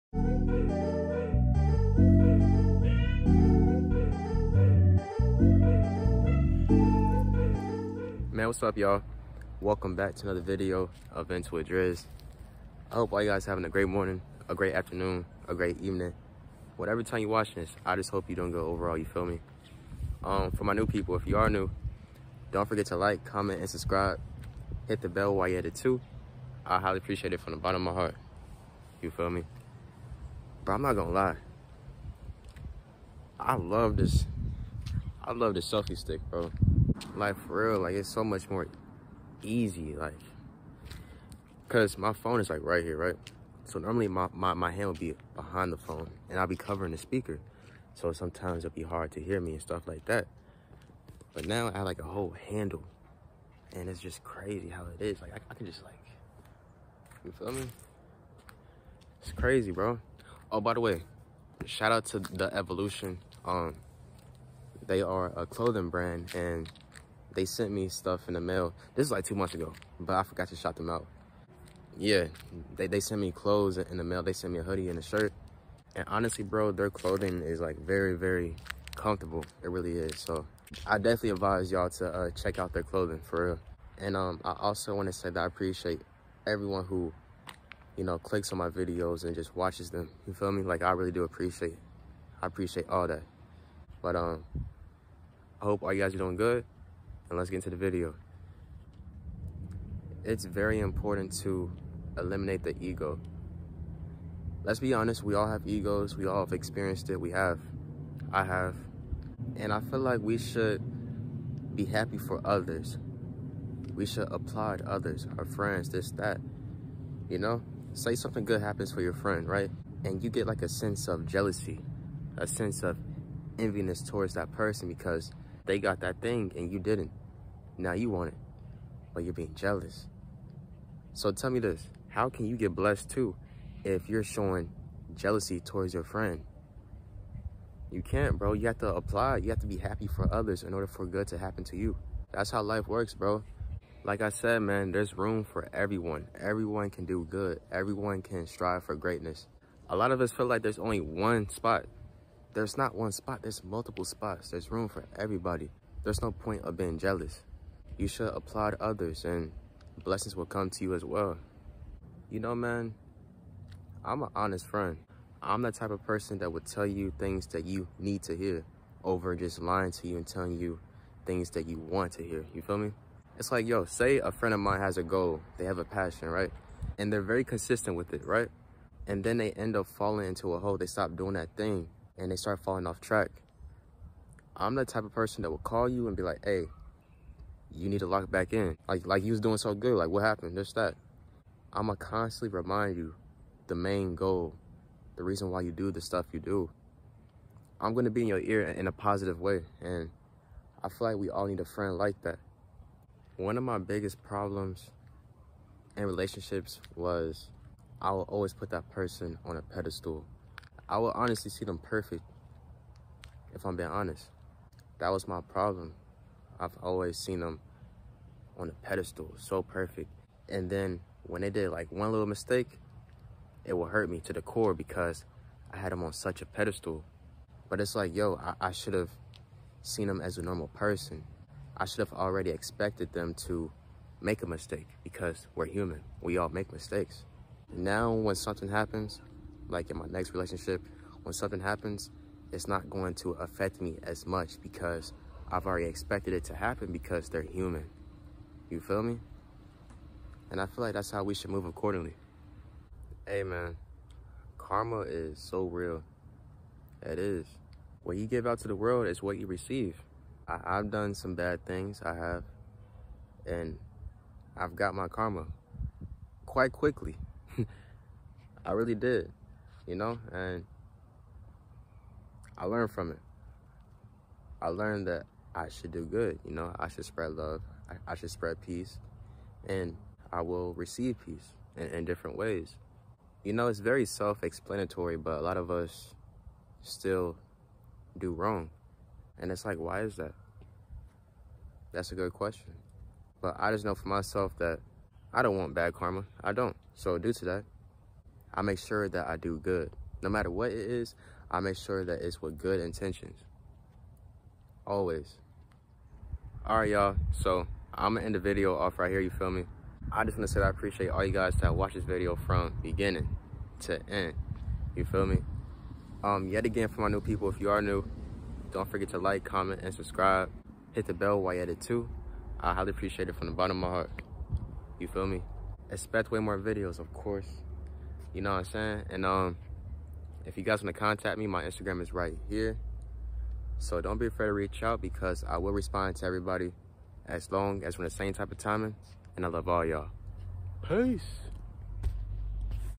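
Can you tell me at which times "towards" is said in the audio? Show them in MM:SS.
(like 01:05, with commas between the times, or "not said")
02:04, 02:15.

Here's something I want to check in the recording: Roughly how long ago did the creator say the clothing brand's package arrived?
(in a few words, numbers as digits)
2 months ago.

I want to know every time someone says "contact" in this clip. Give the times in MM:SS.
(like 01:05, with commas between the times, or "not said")
05:30.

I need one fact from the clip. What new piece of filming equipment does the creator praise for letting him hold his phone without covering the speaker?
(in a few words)
Selfie stick.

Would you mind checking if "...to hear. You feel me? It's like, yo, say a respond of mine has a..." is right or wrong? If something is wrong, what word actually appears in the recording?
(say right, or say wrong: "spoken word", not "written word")
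wrong: "friend", not "respond".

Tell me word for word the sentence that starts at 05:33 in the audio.
So don't be afraid to reach out because I will respond to everybody as long as we're the same type of timing.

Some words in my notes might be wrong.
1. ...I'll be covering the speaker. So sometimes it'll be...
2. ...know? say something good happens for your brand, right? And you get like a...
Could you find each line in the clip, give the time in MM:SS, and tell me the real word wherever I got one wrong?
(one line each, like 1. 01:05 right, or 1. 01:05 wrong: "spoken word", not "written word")
1. 00:46 right
2. 01:57 wrong: "friend", not "brand".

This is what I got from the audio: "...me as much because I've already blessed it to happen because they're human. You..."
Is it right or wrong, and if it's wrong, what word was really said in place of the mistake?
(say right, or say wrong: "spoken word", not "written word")
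wrong: "expected", not "blessed".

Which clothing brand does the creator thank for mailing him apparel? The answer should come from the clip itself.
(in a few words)
The Evolution.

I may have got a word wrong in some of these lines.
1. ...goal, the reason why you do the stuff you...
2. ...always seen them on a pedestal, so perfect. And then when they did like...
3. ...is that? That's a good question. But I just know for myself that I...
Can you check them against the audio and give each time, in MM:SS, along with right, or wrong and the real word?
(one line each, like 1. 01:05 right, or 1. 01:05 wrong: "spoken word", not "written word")
1. 03:14 right
2. 03:36 right
3. 04:50 right.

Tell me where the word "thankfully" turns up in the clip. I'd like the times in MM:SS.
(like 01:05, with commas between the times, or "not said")
not said.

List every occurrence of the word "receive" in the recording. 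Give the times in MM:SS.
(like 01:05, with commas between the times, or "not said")
04:19, 04:40.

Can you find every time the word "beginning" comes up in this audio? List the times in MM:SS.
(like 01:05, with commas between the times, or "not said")
05:12.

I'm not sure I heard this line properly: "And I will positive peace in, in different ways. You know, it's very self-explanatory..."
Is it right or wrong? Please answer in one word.
wrong.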